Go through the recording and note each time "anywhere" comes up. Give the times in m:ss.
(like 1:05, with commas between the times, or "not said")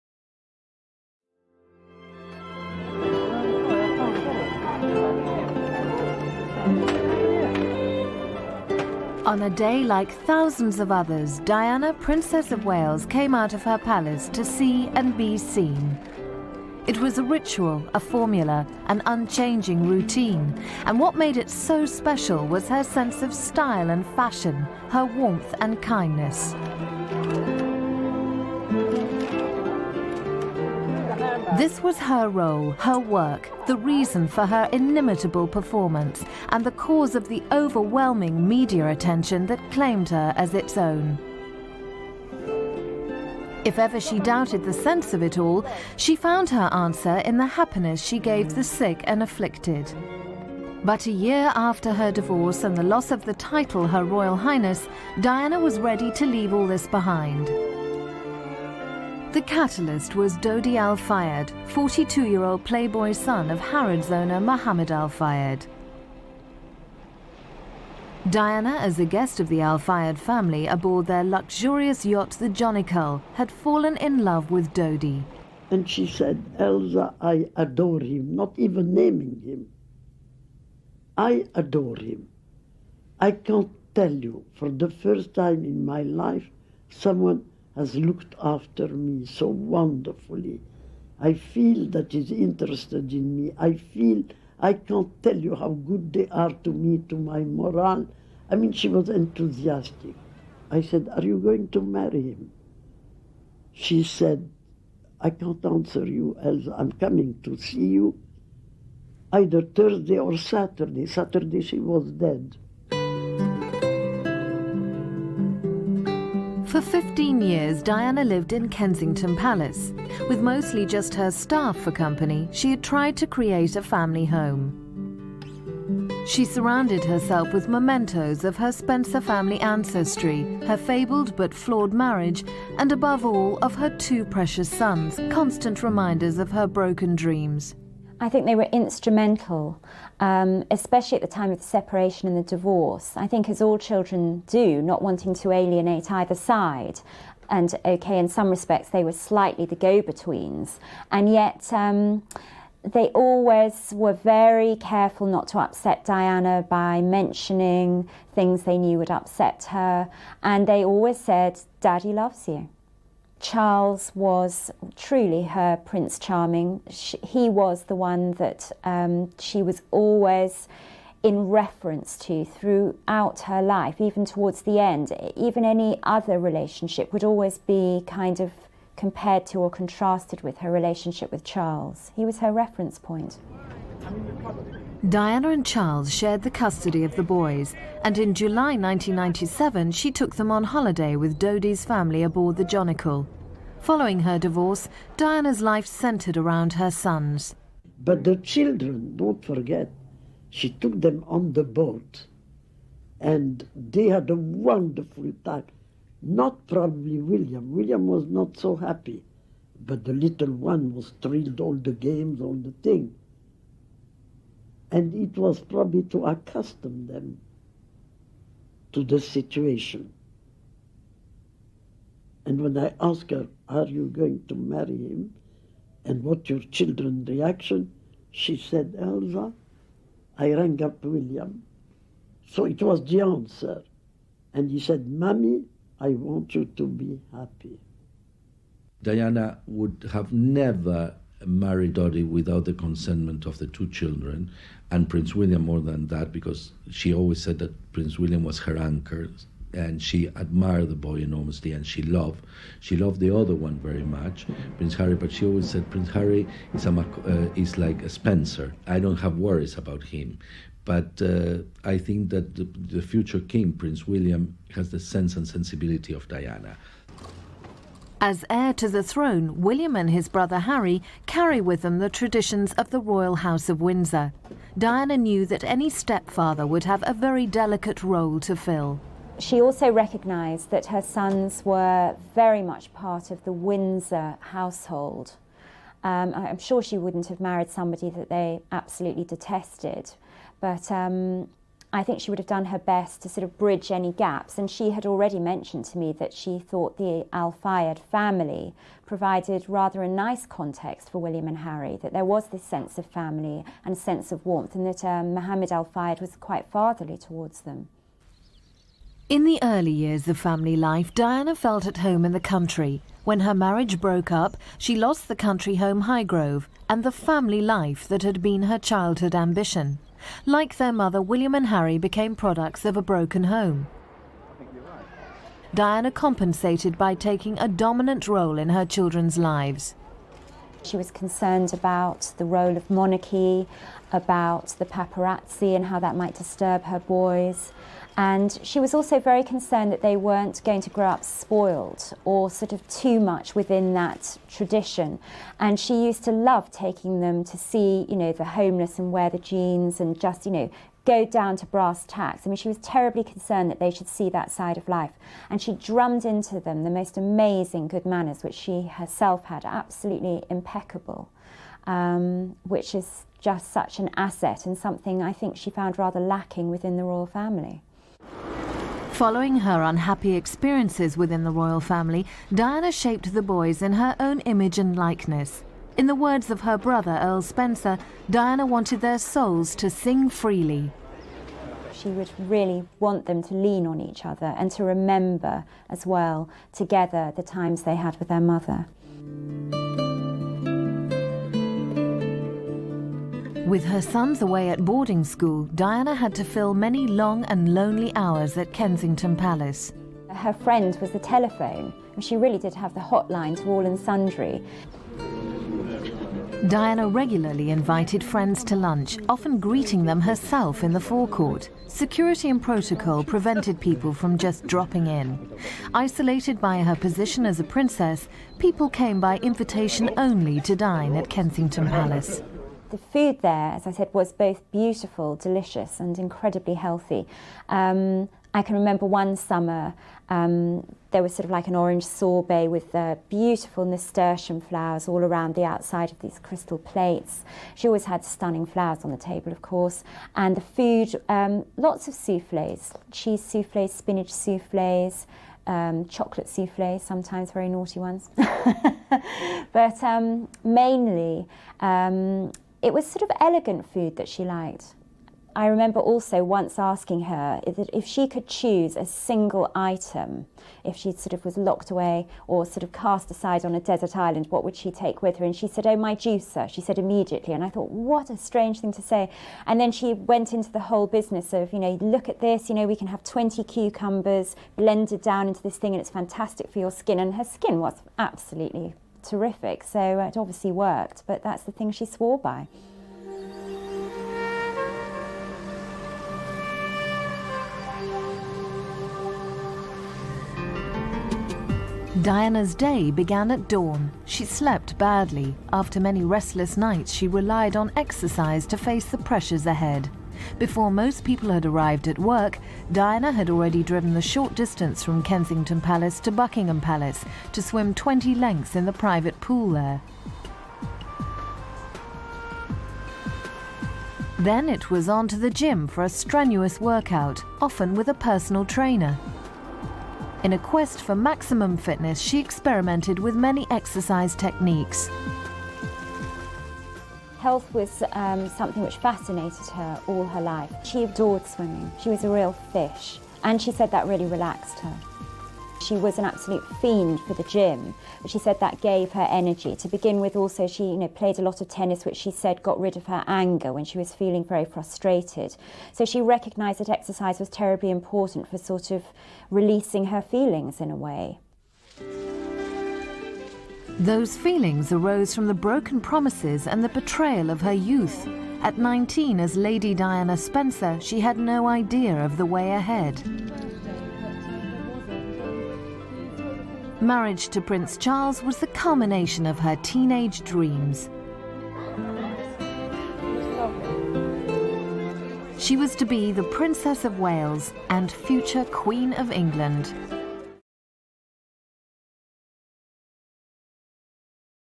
not said.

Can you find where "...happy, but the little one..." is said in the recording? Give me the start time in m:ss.
3:28.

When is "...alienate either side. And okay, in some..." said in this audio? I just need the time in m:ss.
2:25.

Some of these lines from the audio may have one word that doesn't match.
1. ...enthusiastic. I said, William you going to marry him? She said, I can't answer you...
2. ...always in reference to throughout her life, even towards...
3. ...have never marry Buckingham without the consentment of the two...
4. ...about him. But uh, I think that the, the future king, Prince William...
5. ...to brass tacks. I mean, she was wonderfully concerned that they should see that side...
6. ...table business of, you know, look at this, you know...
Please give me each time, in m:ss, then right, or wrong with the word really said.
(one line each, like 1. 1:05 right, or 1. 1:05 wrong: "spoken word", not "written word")
1. 1:39 wrong: "Are", not "William"
2. 2:49 right
3. 4:00 wrong: "Dodi", not "Buckingham"
4. 4:19 right
5. 5:51 wrong: "terribly", not "wonderfully"
6. 7:50 wrong: "whole", not "table".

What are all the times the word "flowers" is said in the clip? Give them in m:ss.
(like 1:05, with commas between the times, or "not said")
7:14, 7:18.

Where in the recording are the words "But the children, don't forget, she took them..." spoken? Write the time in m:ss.
3:17.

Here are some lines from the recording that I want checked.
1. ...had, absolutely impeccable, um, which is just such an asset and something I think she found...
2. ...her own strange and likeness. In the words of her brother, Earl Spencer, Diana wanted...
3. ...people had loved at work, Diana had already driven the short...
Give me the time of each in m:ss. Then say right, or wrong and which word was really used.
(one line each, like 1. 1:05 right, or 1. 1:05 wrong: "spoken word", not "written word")
1. 5:59 right
2. 6:13 wrong: "image", not "strange"
3. 8:21 wrong: "arrived", not "loved".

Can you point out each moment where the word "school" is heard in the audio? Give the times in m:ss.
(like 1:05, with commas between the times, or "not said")
6:35.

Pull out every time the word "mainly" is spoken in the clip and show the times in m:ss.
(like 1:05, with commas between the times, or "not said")
7:30.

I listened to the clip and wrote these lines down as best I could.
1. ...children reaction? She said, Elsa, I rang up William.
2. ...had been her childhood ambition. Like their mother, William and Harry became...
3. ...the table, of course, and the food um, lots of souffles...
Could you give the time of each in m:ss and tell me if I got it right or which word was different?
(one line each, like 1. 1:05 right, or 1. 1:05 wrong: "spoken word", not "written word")
1. 3:46 right
2. 5:18 right
3. 7:19 right.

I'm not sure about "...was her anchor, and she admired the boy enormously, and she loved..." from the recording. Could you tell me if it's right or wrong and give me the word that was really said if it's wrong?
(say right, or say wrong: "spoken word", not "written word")
right.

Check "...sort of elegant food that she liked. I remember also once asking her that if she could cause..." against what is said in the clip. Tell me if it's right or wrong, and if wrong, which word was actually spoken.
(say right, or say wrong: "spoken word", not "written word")
wrong: "choose", not "cause".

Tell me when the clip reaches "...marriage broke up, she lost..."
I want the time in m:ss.
5:13.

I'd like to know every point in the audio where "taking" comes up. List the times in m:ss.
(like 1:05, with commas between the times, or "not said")
5:27, 5:46.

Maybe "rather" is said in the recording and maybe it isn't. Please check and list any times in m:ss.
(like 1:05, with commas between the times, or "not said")
4:59, 6:05.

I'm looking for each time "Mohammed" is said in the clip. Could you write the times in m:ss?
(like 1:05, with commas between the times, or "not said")
1:04, 5:05.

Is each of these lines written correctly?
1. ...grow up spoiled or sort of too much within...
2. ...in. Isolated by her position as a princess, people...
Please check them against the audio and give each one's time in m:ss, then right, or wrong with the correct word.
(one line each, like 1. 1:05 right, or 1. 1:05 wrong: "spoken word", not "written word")
1. 5:40 right
2. 6:55 right.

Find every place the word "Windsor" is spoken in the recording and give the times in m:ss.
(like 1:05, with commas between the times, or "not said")
4:33, 4:43.